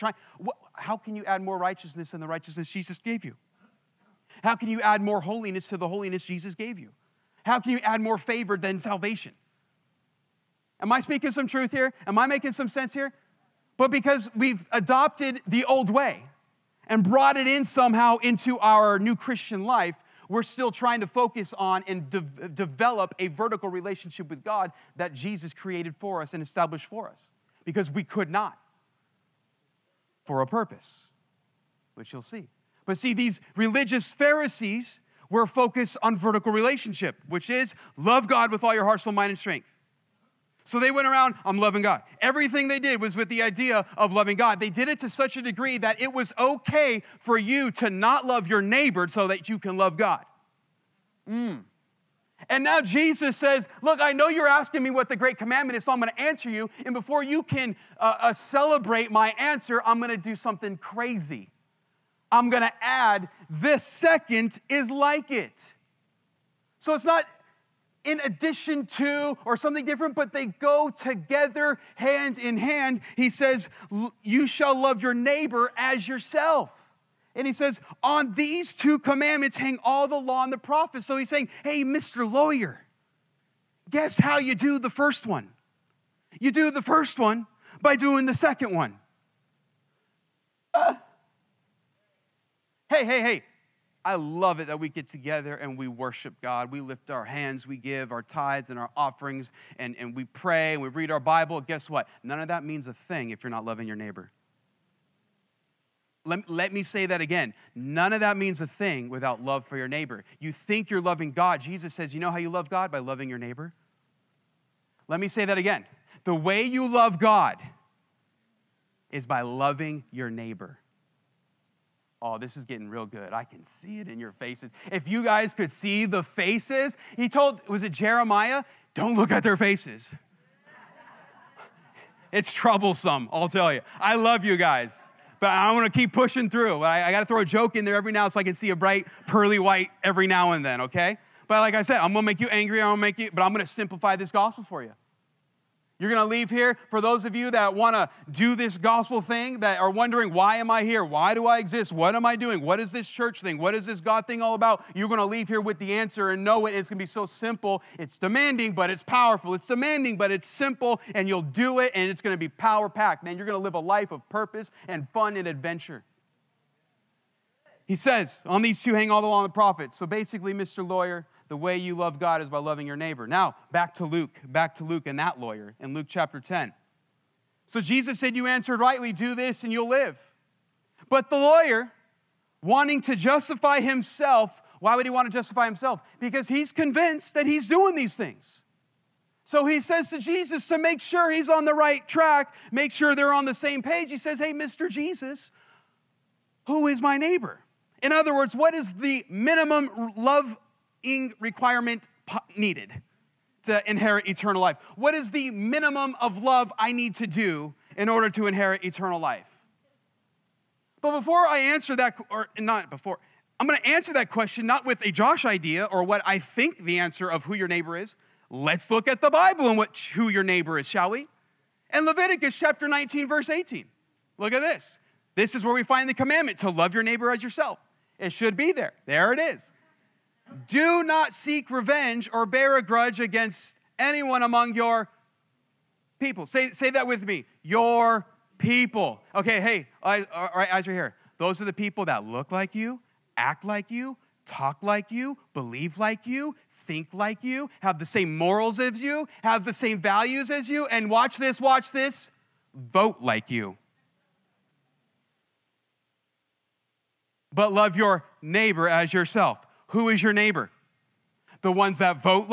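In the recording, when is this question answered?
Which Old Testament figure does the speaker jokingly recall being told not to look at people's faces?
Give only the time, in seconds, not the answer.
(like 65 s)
127 s.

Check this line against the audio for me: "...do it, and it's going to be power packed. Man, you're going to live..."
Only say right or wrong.
right.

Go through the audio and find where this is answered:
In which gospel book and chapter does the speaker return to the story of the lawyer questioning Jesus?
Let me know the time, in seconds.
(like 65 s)
175 s.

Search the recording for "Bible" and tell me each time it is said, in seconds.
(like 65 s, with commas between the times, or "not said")
101 s, 219 s.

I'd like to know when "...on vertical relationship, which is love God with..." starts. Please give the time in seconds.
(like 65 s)
36 s.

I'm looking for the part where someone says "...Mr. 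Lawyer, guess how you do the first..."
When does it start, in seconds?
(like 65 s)
81 s.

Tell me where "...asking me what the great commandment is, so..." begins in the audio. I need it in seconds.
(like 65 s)
54 s.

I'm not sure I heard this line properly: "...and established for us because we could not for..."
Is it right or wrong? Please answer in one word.
right.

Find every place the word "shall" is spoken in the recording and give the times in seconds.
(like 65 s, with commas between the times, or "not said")
74 s, 220 s.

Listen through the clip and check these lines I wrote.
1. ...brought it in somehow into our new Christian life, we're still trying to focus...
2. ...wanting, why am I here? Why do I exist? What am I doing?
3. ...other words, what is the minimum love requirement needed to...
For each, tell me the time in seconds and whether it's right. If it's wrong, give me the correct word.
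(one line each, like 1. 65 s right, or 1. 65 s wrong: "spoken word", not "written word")
1. 17 s right
2. 149 s wrong: "wondering", not "wanting"
3. 198 s right.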